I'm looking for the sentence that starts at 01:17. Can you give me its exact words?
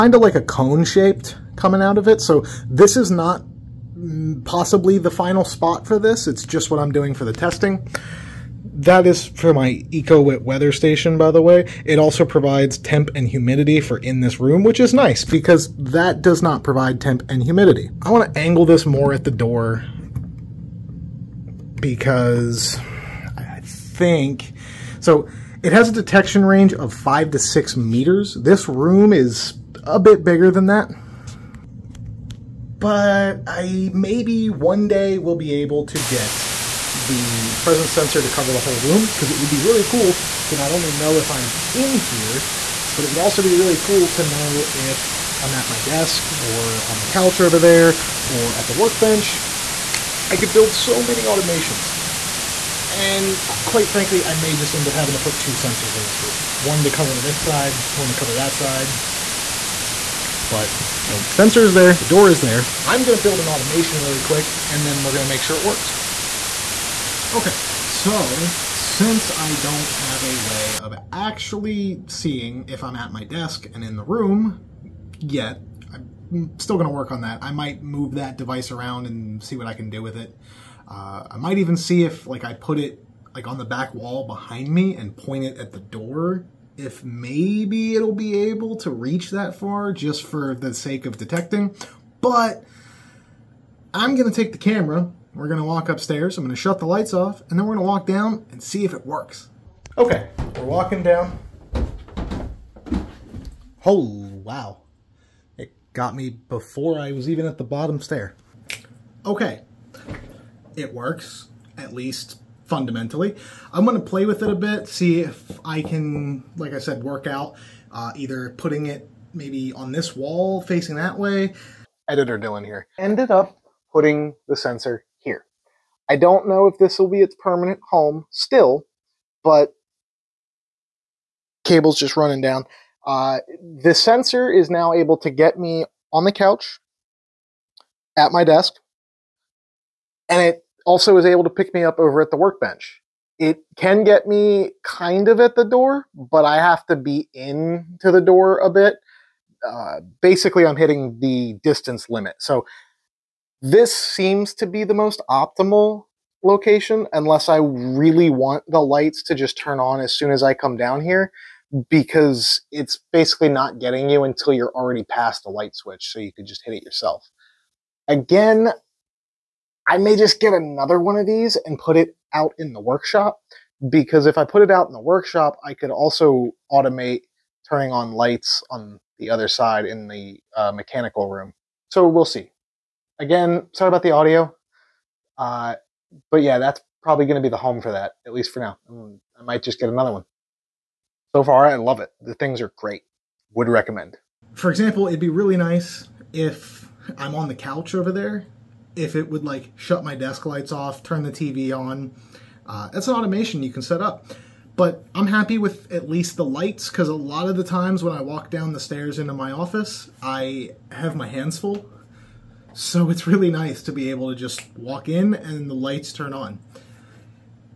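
I might move that device around and see what I can do with it.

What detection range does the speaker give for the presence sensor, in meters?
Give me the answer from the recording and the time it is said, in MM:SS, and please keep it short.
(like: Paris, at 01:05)
5 to 6 meters, at 00:26.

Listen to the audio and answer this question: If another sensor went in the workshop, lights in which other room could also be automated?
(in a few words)
mechanical room.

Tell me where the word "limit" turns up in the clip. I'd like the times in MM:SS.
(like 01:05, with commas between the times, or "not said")
02:32.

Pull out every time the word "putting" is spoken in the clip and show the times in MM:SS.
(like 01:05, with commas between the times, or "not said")
01:58, 02:03.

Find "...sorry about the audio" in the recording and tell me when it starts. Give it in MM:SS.
03:03.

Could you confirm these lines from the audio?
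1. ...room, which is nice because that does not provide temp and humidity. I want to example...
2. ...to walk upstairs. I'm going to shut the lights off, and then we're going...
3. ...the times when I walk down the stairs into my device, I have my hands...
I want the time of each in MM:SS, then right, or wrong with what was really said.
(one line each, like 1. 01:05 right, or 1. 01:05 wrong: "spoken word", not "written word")
1. 00:14 wrong: "angle", not "example"
2. 01:35 right
3. 03:27 wrong: "office", not "device".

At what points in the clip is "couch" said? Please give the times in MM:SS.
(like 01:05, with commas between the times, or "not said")
00:47, 02:16, 03:17.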